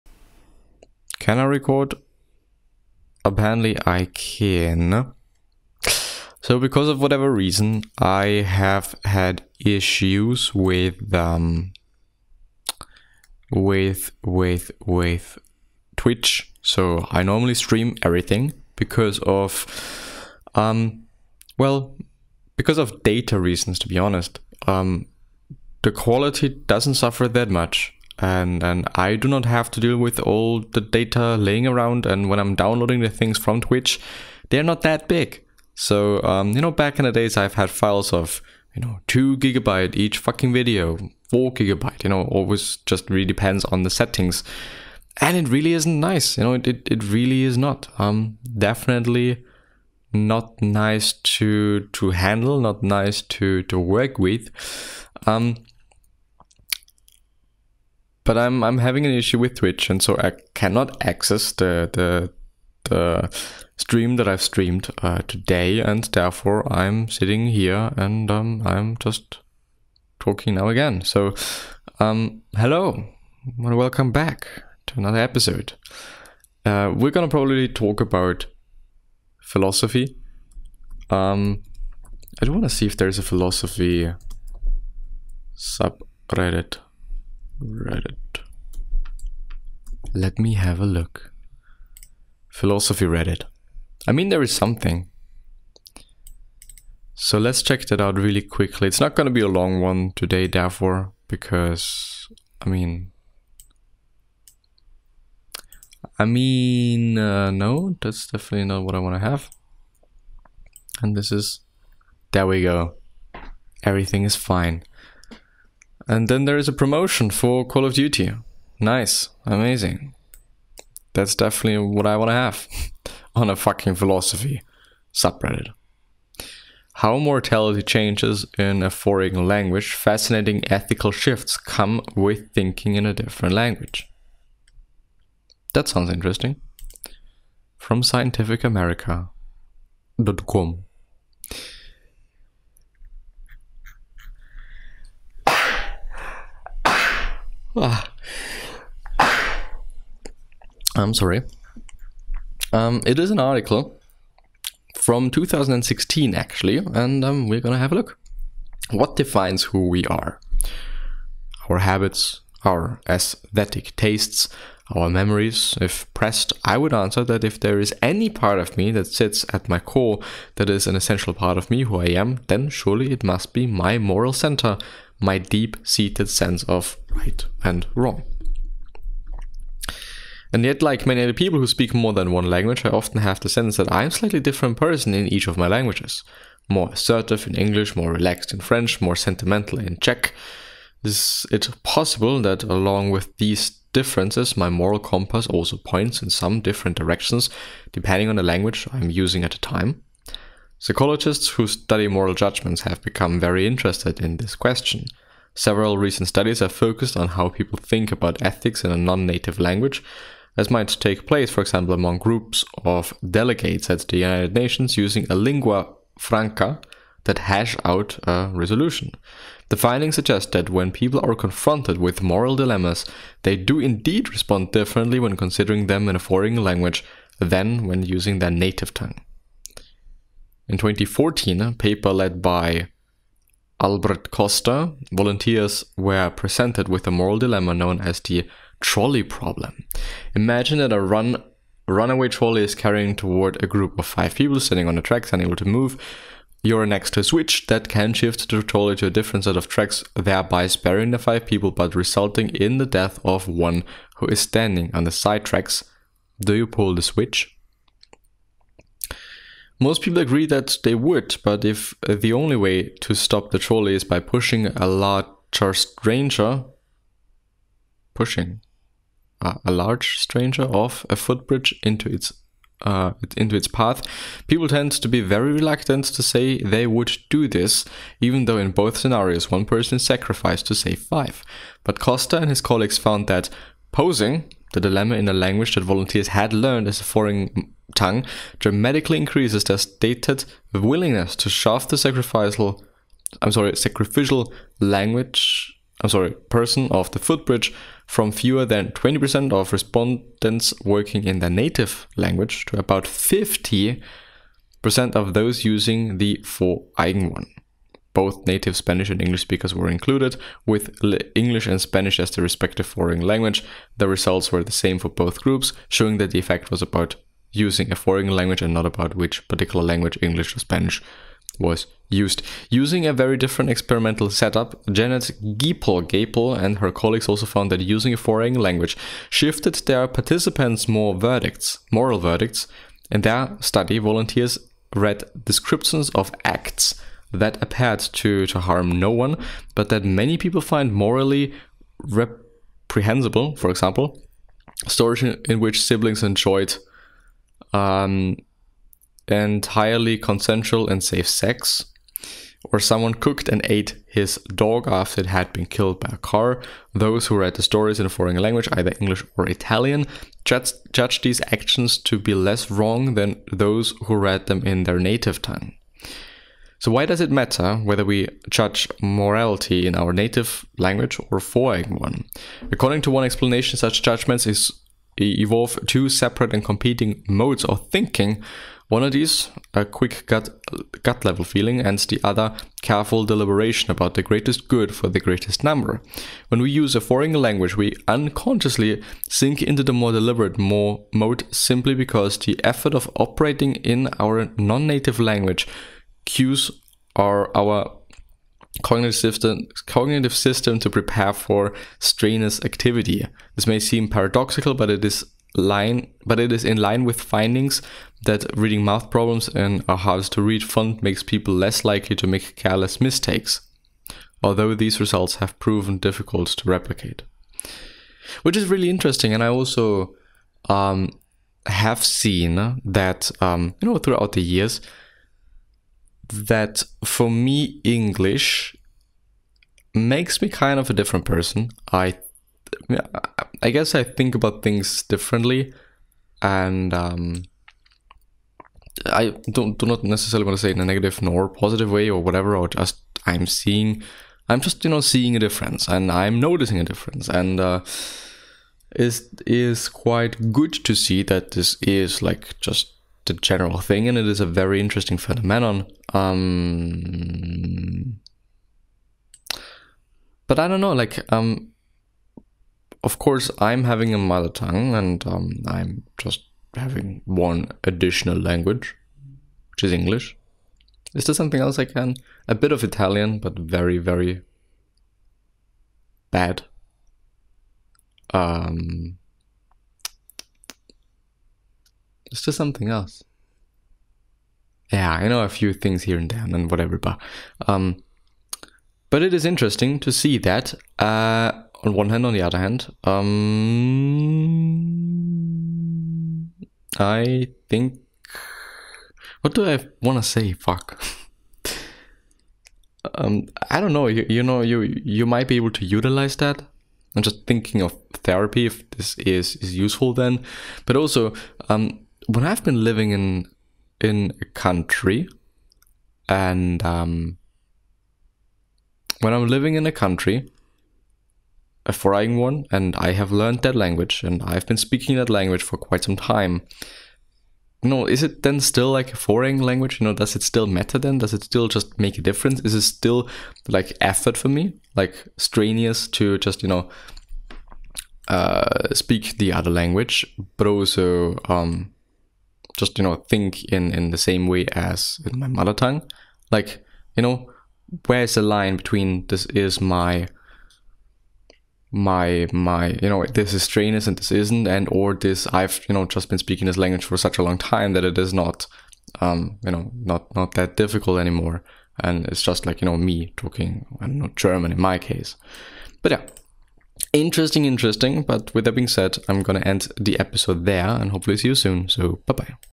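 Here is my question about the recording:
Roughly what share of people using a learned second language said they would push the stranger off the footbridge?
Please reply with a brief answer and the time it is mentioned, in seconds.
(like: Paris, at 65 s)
50%, at 303 s.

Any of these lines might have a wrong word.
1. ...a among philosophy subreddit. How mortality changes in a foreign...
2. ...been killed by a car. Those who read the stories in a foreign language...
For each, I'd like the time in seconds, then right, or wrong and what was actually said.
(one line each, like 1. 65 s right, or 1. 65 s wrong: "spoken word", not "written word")
1. 123 s wrong: "fucking", not "among"
2. 355 s right.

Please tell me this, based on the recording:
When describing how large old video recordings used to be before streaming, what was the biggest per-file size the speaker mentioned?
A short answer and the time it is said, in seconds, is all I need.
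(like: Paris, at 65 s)
4 gigabytes, at 41 s.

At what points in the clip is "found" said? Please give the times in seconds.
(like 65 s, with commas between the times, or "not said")
282 s, 327 s.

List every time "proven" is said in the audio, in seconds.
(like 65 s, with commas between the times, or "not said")
415 s.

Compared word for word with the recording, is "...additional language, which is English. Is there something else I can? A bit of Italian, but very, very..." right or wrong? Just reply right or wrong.
right.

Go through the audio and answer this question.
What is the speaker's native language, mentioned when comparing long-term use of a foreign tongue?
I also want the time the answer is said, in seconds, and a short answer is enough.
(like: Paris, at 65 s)
German, at 564 s.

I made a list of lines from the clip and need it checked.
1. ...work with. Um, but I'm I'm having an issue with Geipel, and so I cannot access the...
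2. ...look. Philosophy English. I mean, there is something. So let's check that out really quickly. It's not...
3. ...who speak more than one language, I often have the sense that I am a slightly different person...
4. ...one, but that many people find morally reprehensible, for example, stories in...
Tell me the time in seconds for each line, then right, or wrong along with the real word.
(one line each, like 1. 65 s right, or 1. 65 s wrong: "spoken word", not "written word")
1. 53 s wrong: "Twitch", not "Geipel"
2. 90 s wrong: "Reddit", not "English"
3. 181 s right
4. 339 s right.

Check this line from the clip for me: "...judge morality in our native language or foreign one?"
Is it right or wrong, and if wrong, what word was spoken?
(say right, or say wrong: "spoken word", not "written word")
right.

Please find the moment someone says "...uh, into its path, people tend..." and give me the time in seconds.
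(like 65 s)
272 s.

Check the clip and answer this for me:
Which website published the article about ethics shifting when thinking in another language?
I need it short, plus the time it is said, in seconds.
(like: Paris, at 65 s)
scientificamerica.com, at 138 s.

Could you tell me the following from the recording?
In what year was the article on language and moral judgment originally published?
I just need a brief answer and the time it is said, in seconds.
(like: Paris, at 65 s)
2016, at 155 s.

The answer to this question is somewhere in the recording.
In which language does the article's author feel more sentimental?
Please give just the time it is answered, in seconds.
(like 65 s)
190 s.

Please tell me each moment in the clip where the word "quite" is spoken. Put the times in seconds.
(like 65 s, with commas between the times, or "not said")
449 s, 525 s.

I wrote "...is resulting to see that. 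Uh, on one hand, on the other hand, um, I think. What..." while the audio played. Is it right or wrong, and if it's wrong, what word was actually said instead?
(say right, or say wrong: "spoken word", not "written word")
wrong: "interesting", not "resulting".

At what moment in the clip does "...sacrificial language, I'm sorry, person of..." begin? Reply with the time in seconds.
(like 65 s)
293 s.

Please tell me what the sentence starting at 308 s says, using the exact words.
Both native Spanish and English speakers were included, with English and Spanish as the respective foreign language.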